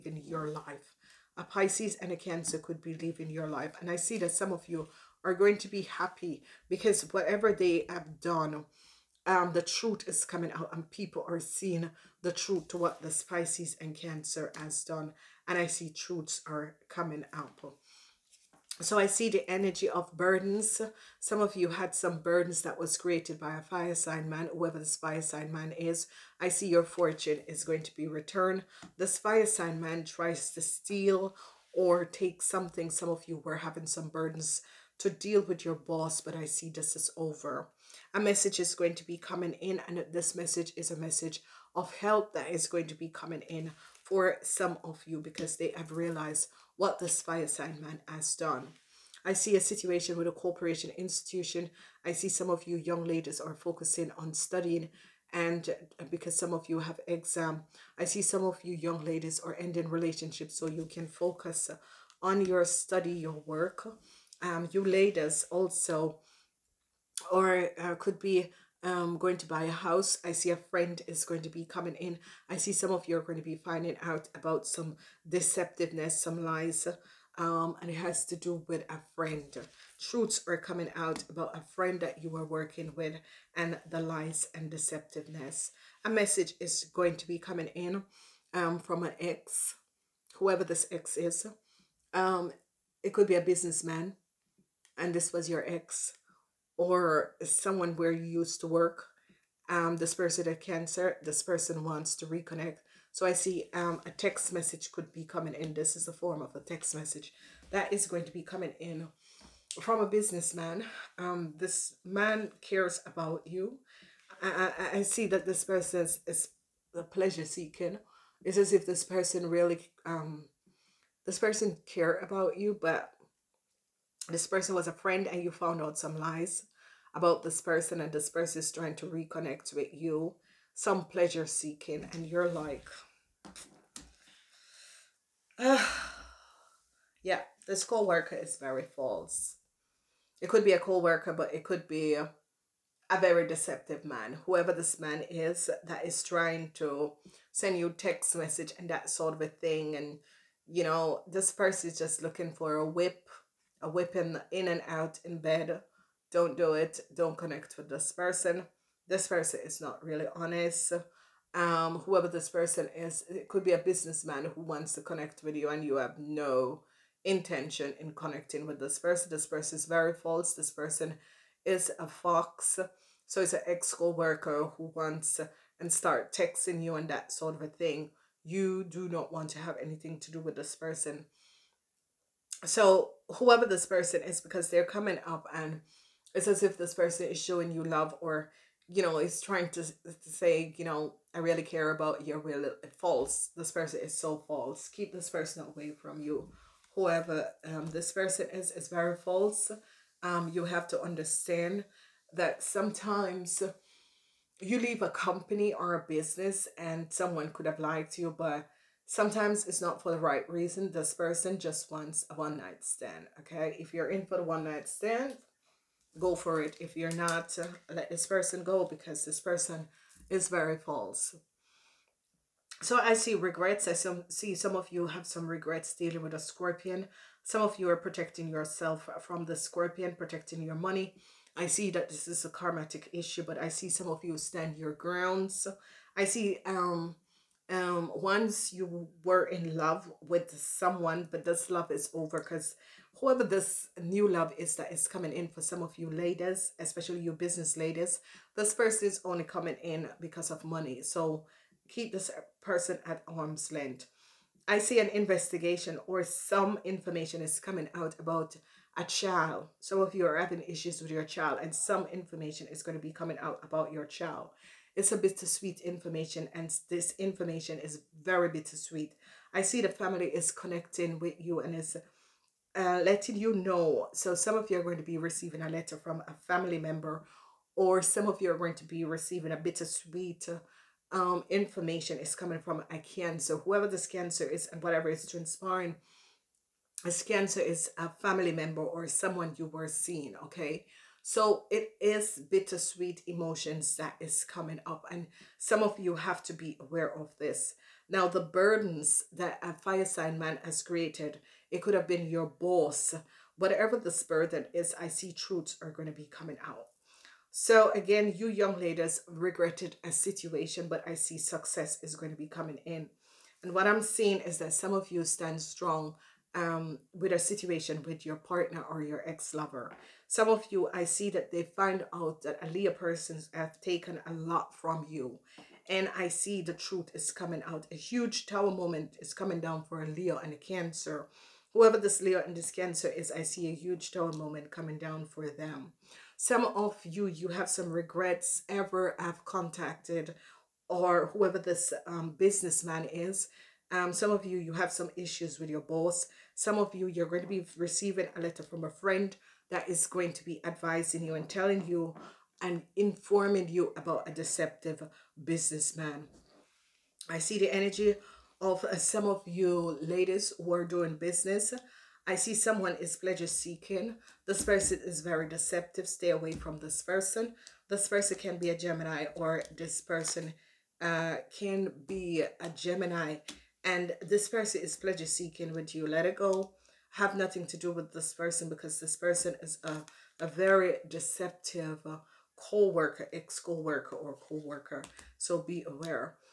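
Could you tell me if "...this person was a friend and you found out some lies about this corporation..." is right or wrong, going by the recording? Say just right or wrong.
wrong.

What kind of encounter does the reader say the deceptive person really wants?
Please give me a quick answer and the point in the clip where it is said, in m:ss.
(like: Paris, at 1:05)
A one night stand, at 3:32.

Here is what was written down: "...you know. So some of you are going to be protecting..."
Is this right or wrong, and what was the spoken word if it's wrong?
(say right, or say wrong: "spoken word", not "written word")
wrong: "receiving", not "protecting".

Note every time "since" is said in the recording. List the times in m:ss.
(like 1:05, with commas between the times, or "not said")
not said.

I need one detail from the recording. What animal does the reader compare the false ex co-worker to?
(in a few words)
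A fox.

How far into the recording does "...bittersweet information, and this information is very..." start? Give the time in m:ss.
4:25.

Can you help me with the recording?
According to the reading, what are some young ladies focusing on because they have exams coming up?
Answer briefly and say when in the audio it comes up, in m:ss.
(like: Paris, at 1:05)
Studying, at 0:54.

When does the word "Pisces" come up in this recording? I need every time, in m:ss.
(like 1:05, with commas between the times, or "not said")
0:01, 0:13.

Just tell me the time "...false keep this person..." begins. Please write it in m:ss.
3:14.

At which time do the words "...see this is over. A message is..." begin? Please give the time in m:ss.
0:36.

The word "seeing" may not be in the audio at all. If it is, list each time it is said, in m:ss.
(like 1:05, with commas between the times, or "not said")
0:11, 4:49, 5:14.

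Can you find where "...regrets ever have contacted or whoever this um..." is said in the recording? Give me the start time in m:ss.
5:37.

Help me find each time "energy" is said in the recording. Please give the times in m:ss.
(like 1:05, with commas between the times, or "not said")
0:19, 5:57.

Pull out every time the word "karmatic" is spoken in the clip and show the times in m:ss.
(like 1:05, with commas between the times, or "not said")
3:52.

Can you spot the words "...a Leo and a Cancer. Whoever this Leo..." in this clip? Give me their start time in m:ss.
5:30.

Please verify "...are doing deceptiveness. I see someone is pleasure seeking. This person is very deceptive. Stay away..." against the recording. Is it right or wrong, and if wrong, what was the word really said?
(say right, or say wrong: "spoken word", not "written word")
wrong: "business", not "deceptiveness".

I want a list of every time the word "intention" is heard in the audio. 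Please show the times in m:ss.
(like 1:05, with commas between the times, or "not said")
2:47.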